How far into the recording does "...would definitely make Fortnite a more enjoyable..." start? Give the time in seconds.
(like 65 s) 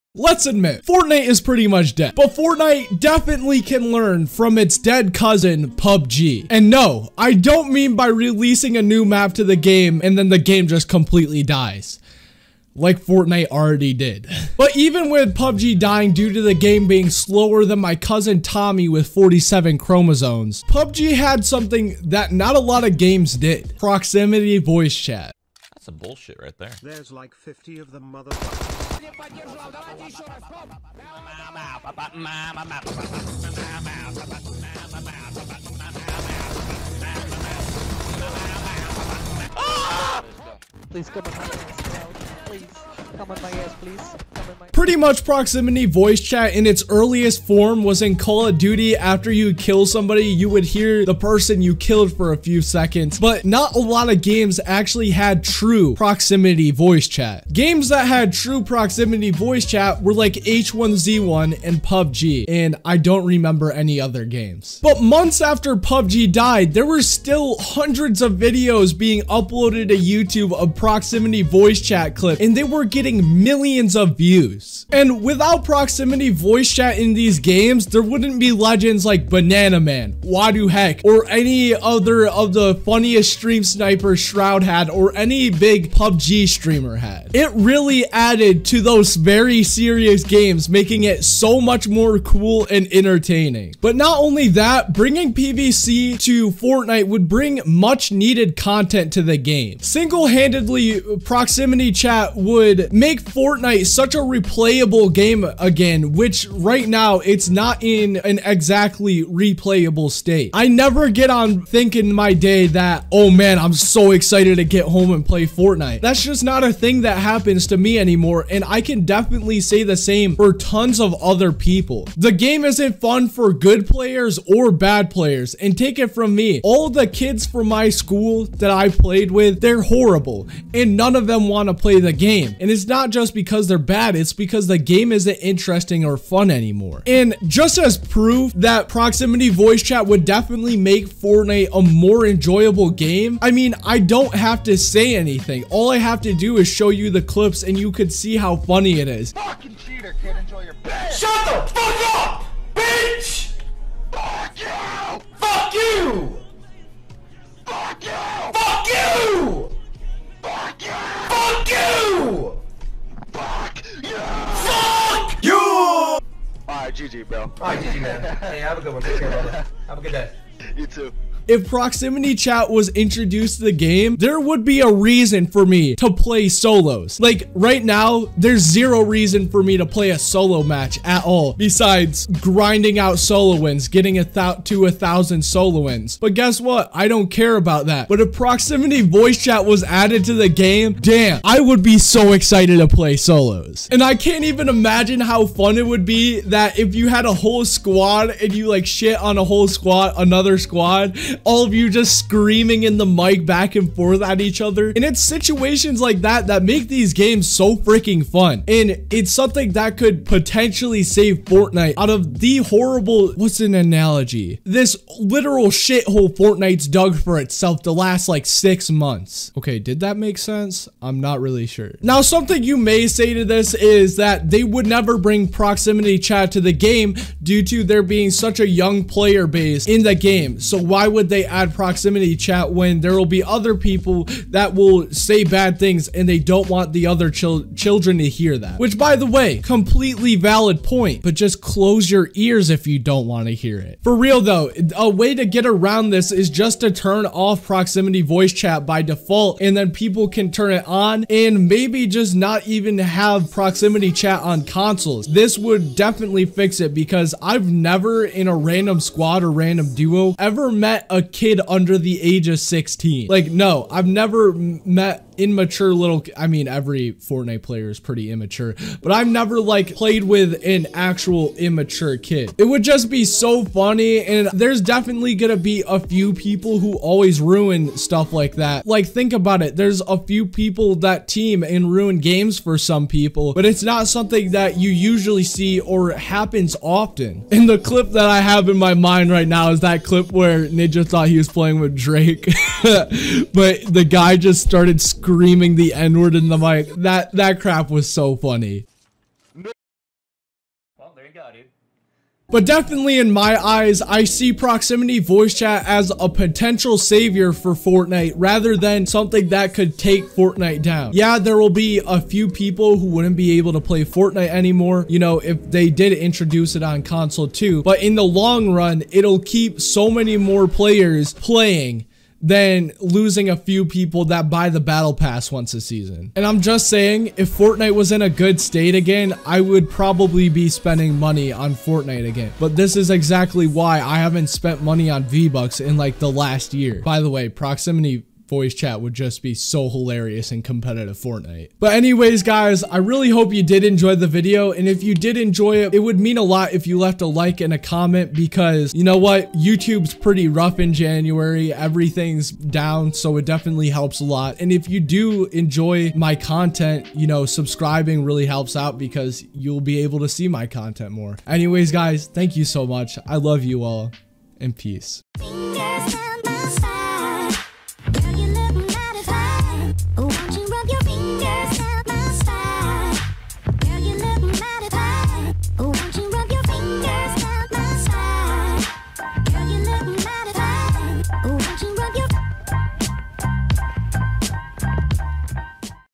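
140 s.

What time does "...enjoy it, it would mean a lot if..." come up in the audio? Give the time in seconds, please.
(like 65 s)
345 s.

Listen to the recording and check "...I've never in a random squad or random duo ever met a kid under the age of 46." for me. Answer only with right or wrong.
wrong.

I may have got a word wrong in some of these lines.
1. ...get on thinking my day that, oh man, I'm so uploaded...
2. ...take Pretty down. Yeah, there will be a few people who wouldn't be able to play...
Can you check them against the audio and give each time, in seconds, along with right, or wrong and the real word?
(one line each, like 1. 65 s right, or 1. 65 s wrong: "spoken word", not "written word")
1. 111 s wrong: "excited", not "uploaded"
2. 309 s wrong: "Fortnite", not "Pretty".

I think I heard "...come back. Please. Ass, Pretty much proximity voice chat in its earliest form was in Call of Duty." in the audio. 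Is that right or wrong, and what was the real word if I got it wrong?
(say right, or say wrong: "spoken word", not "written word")
right.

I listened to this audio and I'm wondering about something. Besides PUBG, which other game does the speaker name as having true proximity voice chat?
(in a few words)
H1Z1.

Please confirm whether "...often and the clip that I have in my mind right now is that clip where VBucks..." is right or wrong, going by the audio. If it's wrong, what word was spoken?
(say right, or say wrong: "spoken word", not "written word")
wrong: "Ninja", not "VBucks".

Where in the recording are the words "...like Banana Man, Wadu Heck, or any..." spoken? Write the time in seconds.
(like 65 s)
79 s.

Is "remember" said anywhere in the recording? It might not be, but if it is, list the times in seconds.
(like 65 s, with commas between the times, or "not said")
63 s.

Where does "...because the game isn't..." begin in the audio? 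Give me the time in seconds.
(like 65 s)
134 s.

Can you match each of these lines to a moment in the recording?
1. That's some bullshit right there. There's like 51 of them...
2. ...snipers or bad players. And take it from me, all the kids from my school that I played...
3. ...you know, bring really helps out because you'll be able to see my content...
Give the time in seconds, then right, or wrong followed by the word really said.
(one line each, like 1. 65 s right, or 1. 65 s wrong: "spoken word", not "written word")
1. 25 s wrong: "50", not "51"
2. 123 s wrong: "players", not "snipers"
3. 357 s wrong: "subscribing", not "bring".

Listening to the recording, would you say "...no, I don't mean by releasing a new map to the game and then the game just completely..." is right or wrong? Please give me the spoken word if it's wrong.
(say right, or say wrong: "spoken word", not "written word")
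right.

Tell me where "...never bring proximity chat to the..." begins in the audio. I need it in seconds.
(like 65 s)
224 s.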